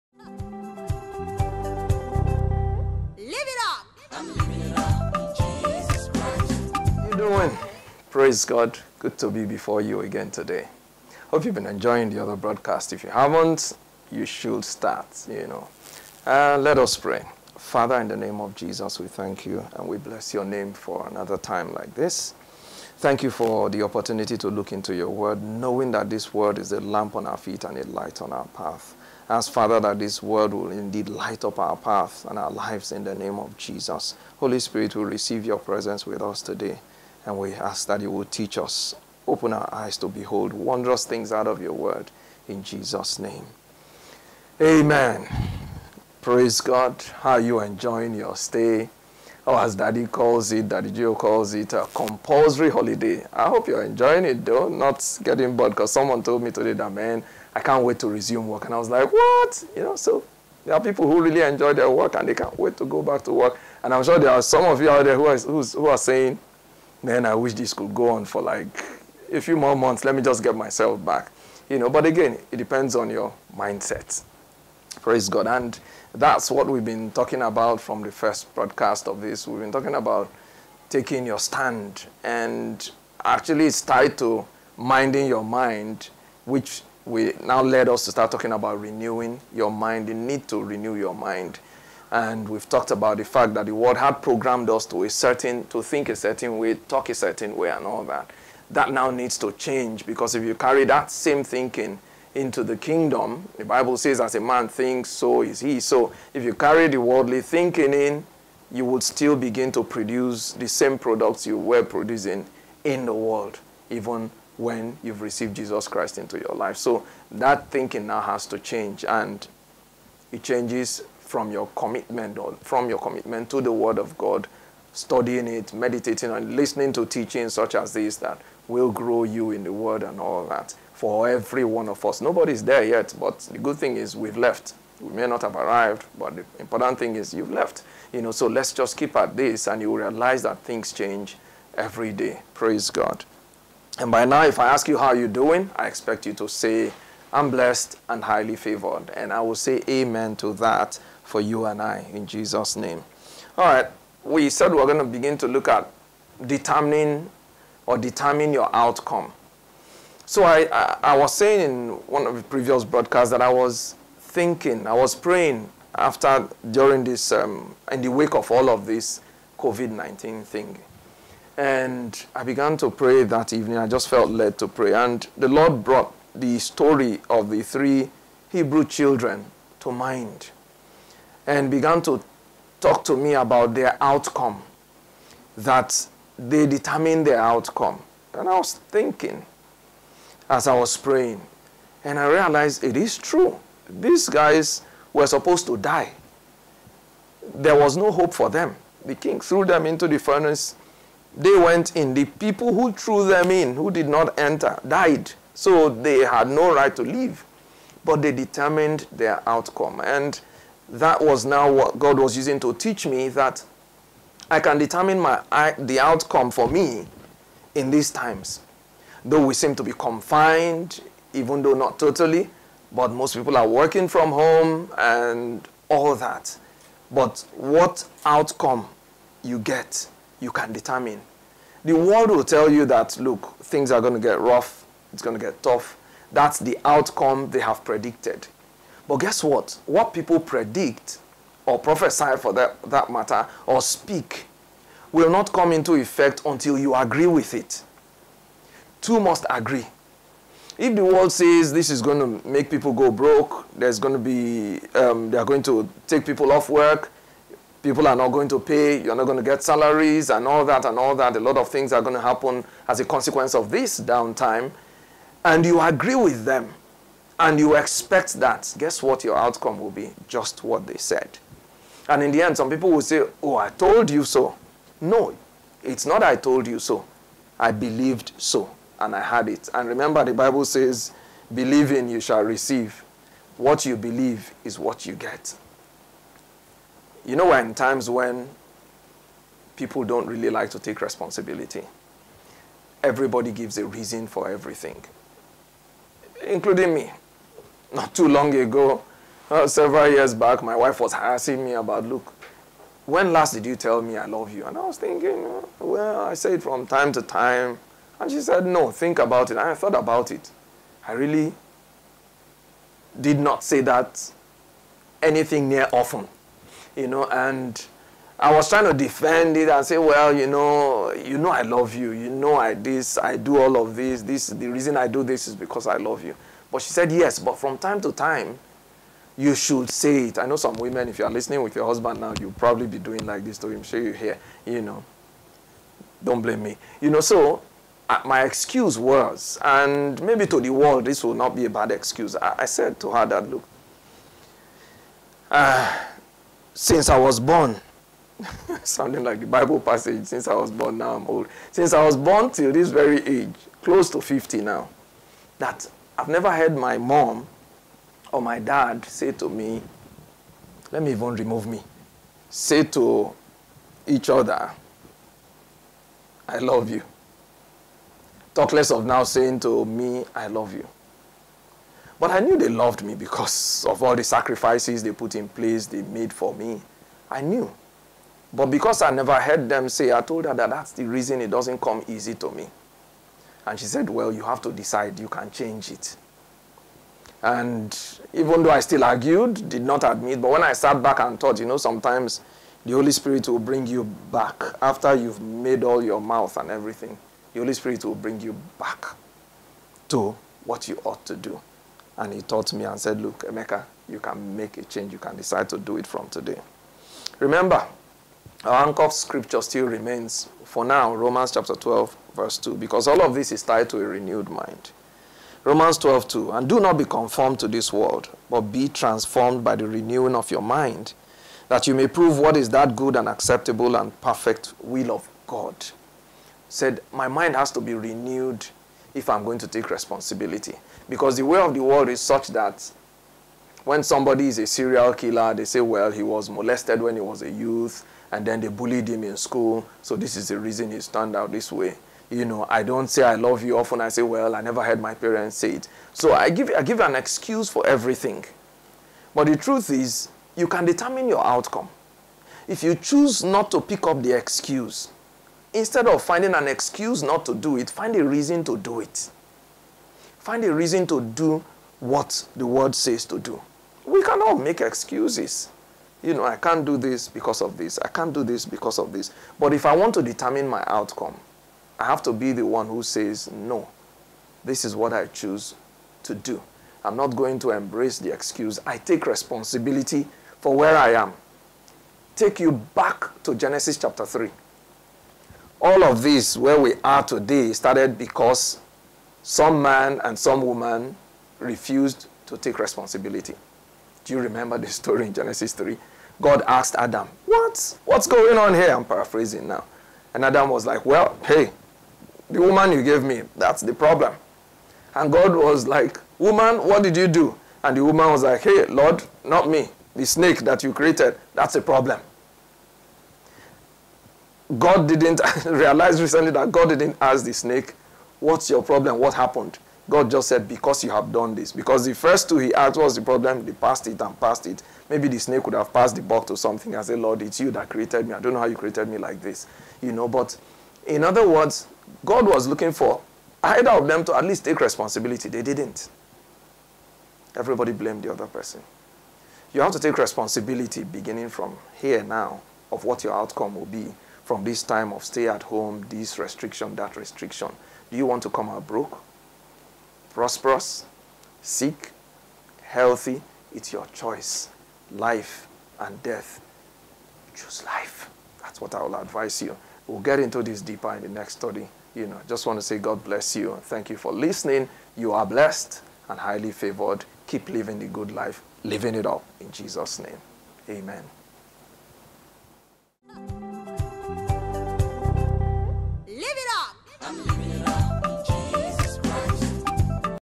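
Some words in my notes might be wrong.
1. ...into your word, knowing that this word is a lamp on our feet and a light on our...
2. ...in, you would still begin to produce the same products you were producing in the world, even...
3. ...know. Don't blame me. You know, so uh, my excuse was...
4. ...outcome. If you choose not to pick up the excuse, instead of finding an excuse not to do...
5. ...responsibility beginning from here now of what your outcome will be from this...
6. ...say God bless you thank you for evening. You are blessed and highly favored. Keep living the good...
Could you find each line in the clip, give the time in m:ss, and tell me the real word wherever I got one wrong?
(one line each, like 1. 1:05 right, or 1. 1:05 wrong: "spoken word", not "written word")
1. 0:24 right
2. 1:47 right
3. 5:34 right
4. 7:31 right
5. 9:00 right
6. 9:22 wrong: "listening", not "evening".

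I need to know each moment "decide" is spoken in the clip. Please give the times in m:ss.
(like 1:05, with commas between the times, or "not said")
6:24, 6:45.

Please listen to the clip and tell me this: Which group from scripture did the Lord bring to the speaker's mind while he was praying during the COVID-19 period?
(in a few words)
three Hebrew children.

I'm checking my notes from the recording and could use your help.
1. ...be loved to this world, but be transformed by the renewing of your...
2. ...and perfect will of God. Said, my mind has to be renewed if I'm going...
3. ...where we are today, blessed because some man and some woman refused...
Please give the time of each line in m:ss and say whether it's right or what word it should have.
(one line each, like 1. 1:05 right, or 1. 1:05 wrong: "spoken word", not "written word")
1. 6:56 wrong: "conformed", not "loved"
2. 7:03 right
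3. 8:06 wrong: "started", not "blessed".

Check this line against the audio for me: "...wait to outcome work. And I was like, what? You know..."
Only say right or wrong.
wrong.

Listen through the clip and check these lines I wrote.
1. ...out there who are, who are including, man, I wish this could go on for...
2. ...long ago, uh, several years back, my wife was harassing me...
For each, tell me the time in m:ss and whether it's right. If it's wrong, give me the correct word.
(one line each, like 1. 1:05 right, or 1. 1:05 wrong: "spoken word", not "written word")
1. 1:04 wrong: "saying", not "including"
2. 4:58 right.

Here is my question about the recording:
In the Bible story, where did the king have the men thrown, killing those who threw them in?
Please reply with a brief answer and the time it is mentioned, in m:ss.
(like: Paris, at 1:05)
the furnace, at 3:20.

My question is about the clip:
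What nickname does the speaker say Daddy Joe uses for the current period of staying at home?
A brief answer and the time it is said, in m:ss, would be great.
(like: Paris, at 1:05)
compulsory holiday, at 0:51.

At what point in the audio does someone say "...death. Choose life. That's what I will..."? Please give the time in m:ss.
9:16.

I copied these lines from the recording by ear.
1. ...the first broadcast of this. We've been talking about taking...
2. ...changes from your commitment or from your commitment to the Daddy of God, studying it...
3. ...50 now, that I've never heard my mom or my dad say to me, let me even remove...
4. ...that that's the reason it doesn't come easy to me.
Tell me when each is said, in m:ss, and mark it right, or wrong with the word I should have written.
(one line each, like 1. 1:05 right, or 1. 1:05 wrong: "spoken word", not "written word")
1. 1:18 right
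2. 2:00 wrong: "Word", not "Daddy"
3. 5:54 right
4. 6:20 right.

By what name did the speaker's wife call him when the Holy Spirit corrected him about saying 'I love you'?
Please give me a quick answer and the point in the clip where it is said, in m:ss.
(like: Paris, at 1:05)
Emeka, at 6:43.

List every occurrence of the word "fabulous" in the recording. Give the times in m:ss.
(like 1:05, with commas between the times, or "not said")
not said.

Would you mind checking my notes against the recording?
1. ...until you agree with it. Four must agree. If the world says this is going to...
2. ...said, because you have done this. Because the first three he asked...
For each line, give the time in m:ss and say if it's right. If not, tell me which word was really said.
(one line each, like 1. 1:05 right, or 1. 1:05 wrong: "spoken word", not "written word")
1. 4:06 wrong: "Two", not "Four"
2. 8:40 wrong: "two", not "three".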